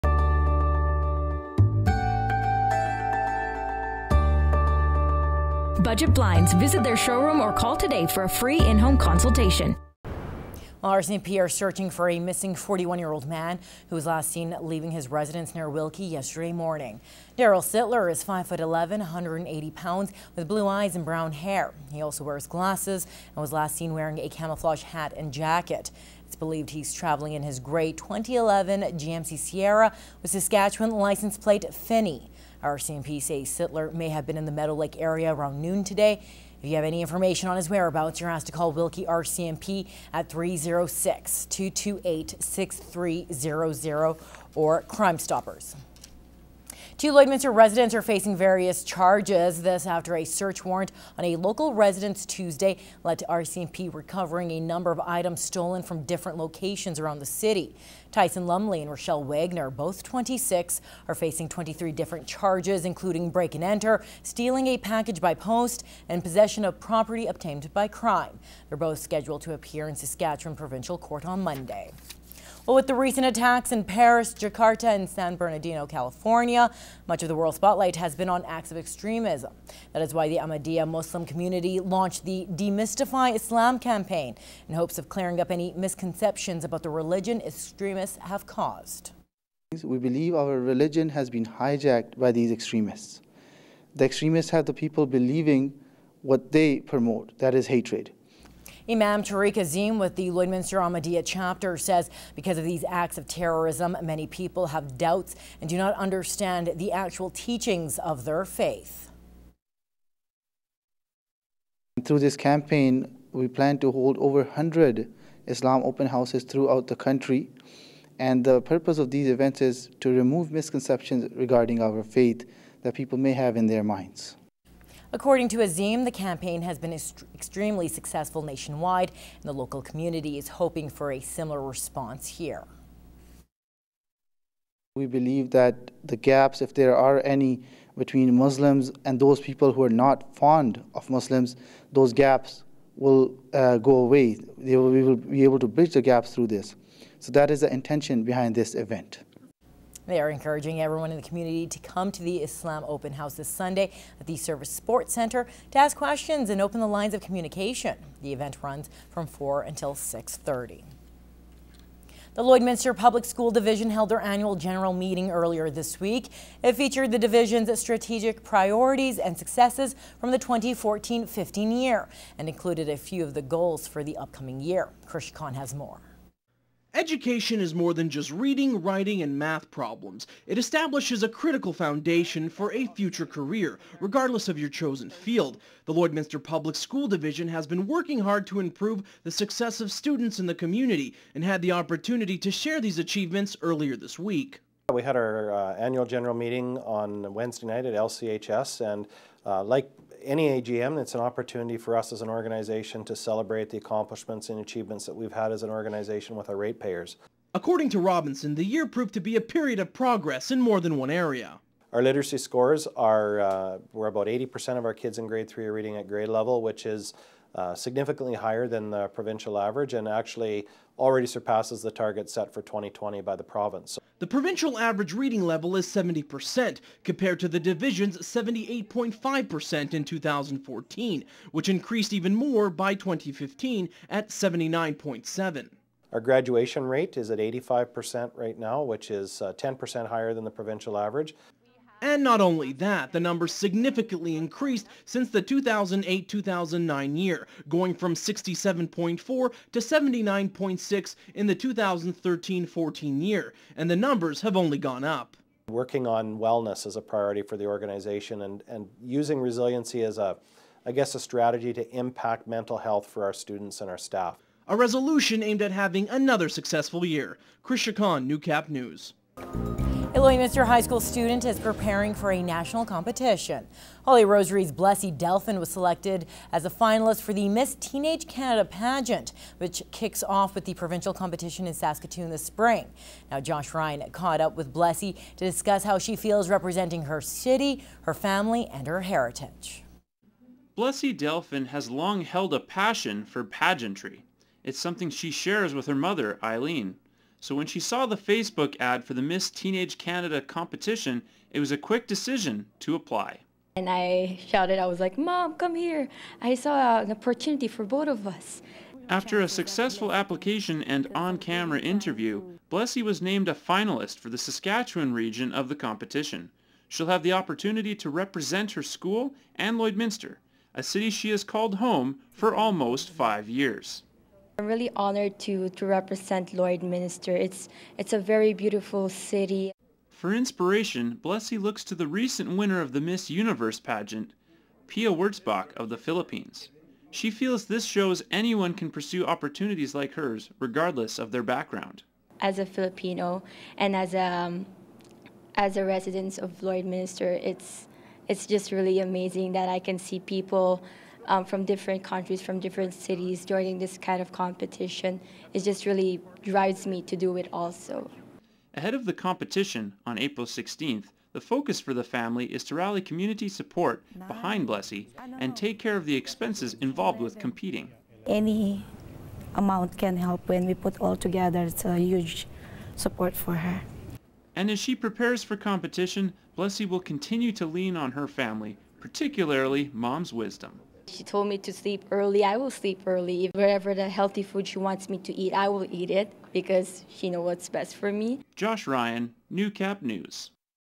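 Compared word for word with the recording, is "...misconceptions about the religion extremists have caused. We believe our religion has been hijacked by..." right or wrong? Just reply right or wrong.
right.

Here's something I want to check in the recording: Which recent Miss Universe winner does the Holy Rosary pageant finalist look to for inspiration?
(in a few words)
Pia Wurtzbach.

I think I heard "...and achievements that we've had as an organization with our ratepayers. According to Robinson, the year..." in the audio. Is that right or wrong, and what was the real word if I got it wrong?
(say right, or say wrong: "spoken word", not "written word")
right.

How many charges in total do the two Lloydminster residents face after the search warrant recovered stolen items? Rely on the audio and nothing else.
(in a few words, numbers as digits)
23.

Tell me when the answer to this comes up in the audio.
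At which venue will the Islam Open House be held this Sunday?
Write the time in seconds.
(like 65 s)
154 s.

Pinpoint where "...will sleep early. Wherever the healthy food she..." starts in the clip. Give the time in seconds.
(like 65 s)
382 s.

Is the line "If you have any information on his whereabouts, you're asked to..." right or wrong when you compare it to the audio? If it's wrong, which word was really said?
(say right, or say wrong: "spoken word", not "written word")
right.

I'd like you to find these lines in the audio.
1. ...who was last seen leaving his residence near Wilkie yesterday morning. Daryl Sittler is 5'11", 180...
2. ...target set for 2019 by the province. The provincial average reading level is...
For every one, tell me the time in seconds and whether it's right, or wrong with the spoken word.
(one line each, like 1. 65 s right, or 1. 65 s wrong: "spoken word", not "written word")
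1. 13 s right
2. 221 s wrong: "2020", not "2019".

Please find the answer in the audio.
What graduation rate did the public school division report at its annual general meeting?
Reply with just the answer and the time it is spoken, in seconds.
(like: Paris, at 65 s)
85%, at 237 s.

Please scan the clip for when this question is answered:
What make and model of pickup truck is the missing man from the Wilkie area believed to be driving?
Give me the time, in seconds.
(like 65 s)
28 s.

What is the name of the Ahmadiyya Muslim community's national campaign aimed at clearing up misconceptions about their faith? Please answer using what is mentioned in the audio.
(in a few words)
Demystify Islam.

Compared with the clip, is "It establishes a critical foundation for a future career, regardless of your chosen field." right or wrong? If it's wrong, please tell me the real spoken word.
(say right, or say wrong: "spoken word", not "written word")
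right.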